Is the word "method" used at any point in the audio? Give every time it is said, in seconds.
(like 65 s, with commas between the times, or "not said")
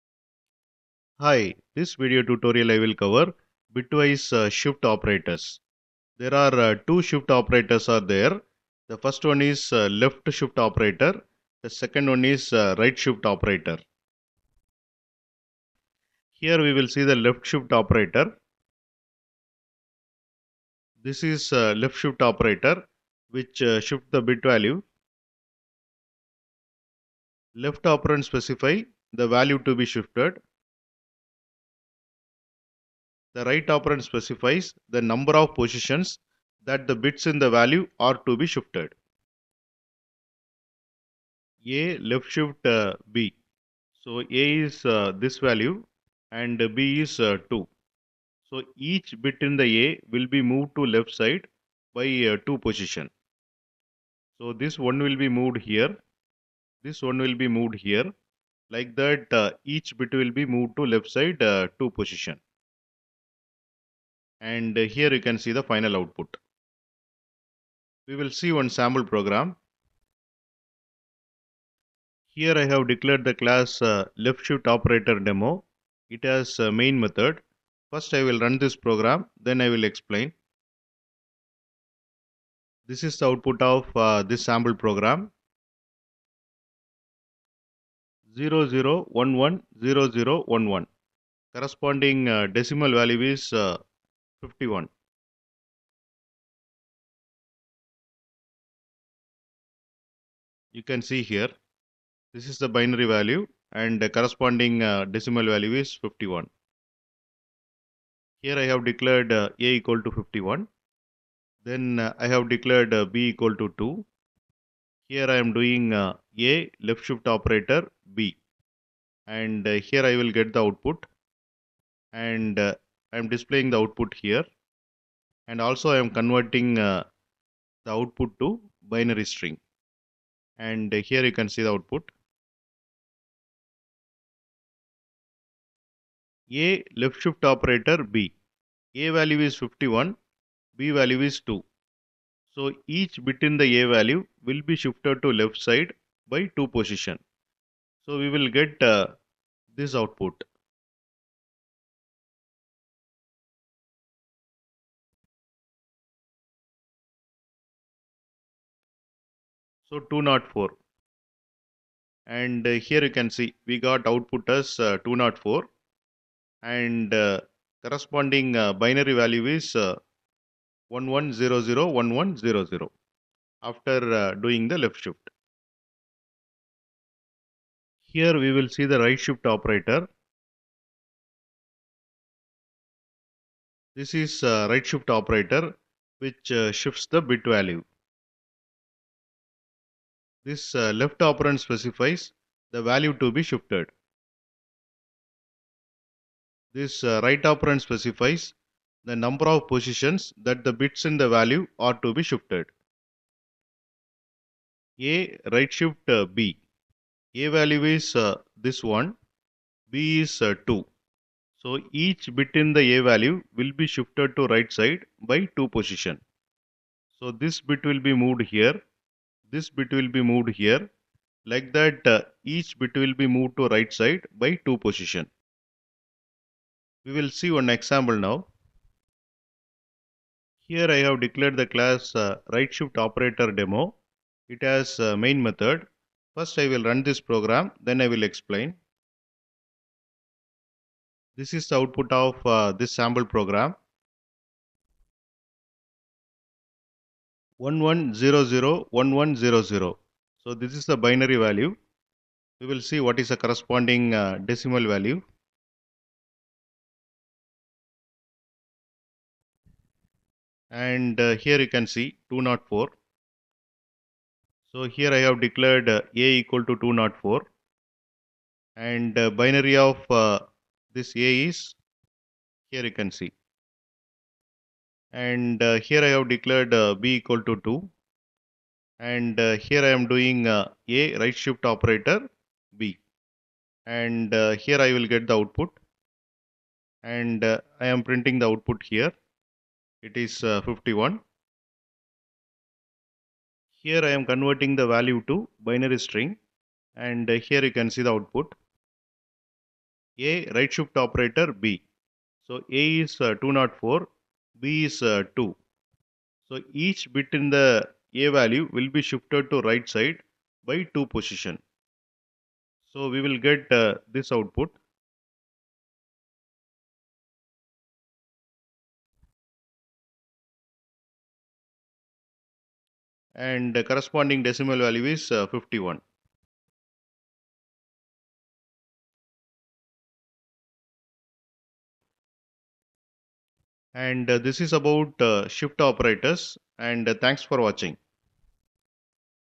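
76 s, 235 s.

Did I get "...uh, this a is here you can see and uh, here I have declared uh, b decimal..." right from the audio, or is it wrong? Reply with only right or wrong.
wrong.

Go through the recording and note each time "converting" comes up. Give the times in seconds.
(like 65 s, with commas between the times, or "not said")
126 s, 294 s.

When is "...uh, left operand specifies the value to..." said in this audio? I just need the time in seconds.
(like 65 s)
190 s.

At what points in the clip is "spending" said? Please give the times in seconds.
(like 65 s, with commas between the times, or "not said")
not said.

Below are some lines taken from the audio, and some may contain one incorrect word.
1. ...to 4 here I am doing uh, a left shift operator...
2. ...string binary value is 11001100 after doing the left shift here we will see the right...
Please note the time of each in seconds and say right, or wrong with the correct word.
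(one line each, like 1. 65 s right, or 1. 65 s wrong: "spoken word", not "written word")
1. 113 s wrong: "2", not "4"
2. 167 s wrong: "corresponding", not "string".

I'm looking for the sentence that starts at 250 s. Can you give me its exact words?
So this is the binary value.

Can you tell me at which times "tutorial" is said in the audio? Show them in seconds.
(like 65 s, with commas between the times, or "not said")
2 s.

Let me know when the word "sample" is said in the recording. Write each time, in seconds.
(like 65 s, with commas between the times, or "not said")
68 s, 84 s, 243 s.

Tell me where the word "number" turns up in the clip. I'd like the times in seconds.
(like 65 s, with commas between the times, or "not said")
35 s, 199 s.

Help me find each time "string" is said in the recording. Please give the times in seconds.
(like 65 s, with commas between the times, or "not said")
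129 s, 295 s.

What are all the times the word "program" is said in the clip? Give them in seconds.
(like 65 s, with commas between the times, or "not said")
69 s, 78 s, 84 s, 237 s, 243 s.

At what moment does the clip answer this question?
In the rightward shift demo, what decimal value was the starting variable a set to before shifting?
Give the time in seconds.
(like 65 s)
266 s.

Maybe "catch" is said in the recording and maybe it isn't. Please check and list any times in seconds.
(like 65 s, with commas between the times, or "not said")
not said.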